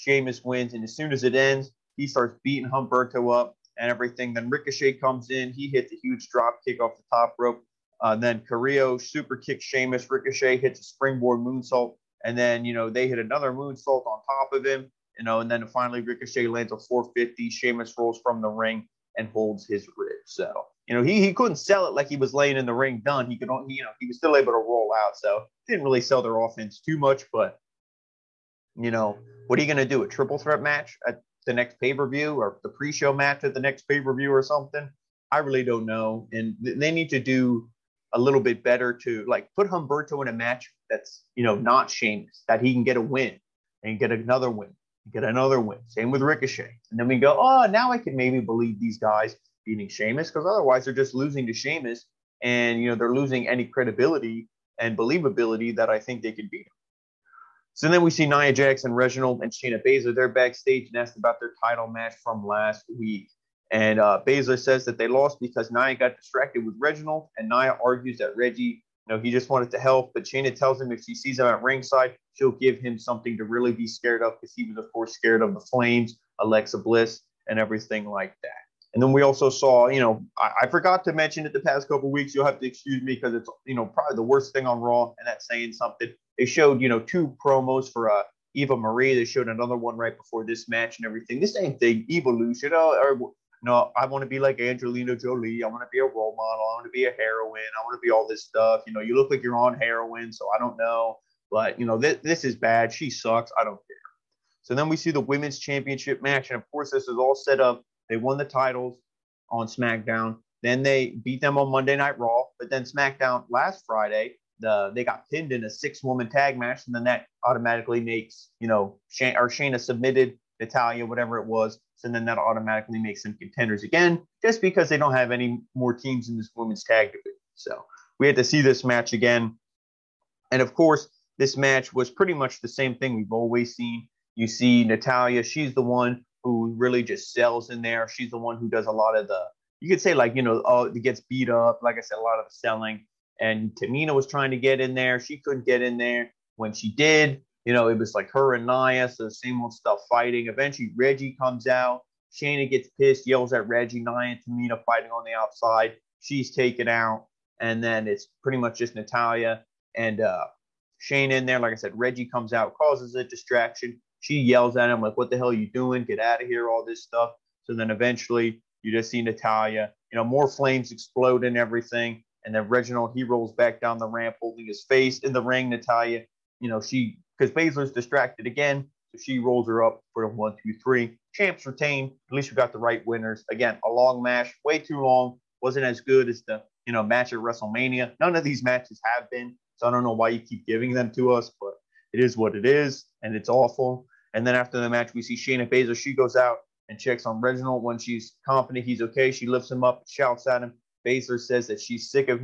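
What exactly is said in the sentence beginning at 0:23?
He could, you know, he was still able to roll out.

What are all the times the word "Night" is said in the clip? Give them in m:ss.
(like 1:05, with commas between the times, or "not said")
1:51.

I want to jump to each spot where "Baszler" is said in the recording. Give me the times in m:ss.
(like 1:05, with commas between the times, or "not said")
0:59, 1:04, 2:57, 3:15, 3:21.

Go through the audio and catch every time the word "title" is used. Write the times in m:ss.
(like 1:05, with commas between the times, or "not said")
1:01, 1:48.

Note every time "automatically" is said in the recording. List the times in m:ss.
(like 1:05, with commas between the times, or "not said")
1:57, 2:02.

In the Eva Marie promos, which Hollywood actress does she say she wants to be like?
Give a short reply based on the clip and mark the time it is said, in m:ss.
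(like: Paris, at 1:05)
Angelina Jolie, at 1:34.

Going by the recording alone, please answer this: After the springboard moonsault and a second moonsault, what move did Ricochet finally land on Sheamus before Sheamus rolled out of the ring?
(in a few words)
450.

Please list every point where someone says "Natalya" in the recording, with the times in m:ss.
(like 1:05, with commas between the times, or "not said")
2:00, 2:14, 2:38, 2:49, 2:55.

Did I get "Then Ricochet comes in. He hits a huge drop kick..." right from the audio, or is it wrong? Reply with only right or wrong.
right.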